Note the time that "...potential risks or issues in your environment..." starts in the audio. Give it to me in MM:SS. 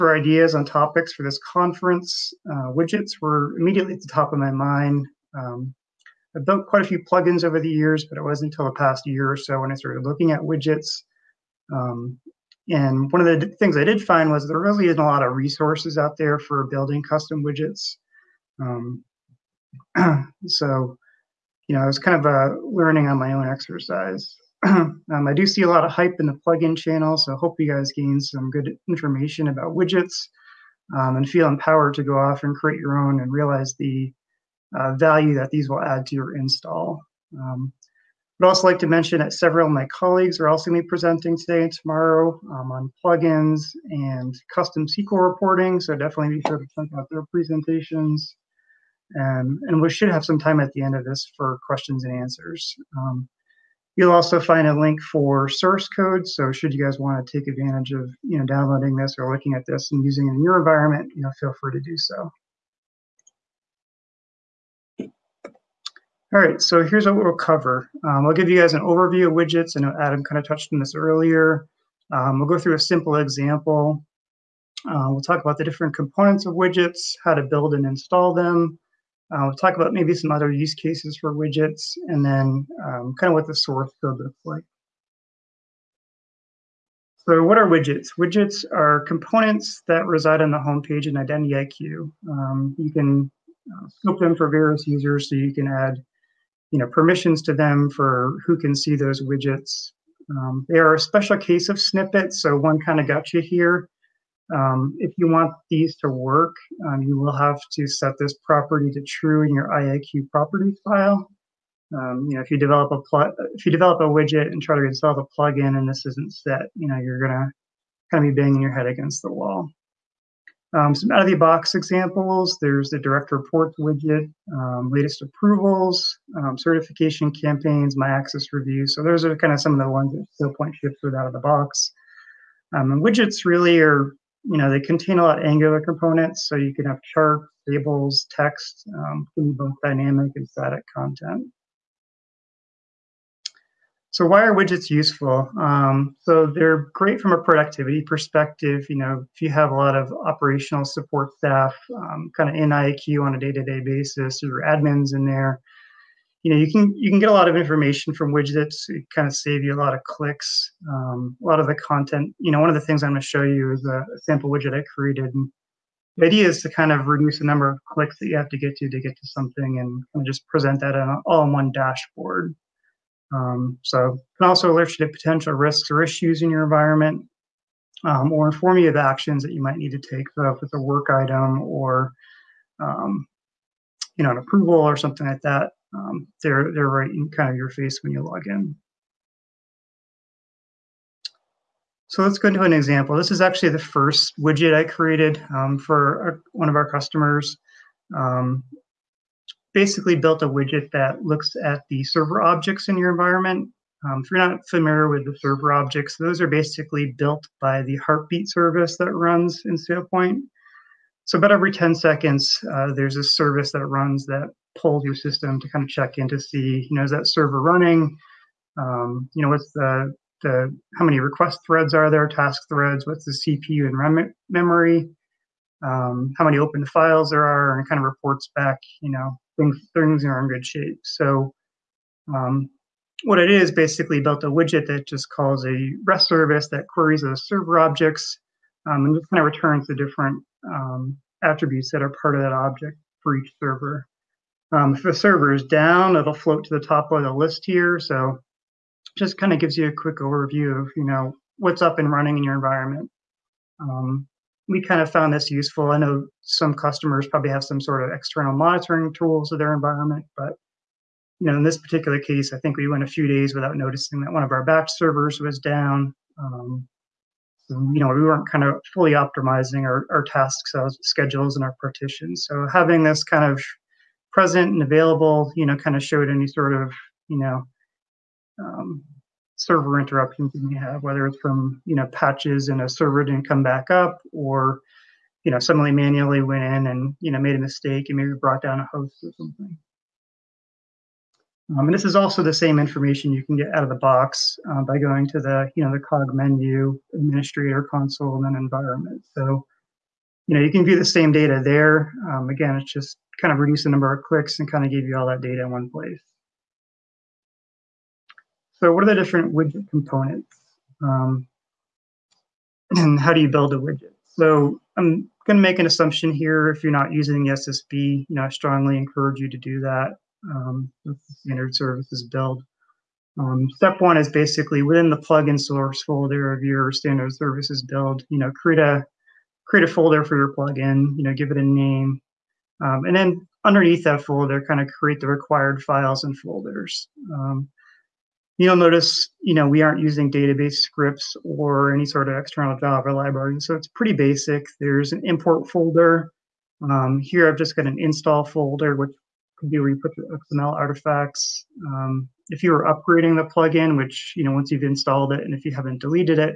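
02:55.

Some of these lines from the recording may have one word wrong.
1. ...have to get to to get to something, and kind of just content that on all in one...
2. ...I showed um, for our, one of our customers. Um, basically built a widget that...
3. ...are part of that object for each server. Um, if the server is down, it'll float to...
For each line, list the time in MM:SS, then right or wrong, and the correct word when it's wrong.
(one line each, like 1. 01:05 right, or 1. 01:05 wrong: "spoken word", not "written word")
1. 02:48 wrong: "present", not "content"
2. 03:14 wrong: "created", not "showed"
3. 04:02 right.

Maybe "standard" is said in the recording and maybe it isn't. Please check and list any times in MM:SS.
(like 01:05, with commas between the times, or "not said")
05:21, 05:26.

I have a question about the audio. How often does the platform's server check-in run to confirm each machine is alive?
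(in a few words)
10 seconds.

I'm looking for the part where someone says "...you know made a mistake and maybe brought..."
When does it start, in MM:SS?
04:47.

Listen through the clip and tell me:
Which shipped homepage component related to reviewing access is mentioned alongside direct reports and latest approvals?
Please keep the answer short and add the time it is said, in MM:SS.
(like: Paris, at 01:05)
My access review, at 02:07.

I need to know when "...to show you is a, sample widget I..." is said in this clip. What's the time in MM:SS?
02:43.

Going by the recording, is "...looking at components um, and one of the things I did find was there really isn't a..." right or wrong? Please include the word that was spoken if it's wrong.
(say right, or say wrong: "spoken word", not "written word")
wrong: "widgets", not "components".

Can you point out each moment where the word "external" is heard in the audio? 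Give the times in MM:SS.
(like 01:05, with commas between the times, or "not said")
04:18, 05:42.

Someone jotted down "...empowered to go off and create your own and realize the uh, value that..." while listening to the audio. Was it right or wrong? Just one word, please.
right.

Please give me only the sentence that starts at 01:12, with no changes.
Um, we'll go through a simple example.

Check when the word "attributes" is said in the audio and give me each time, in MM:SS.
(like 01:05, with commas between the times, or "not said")
04:01.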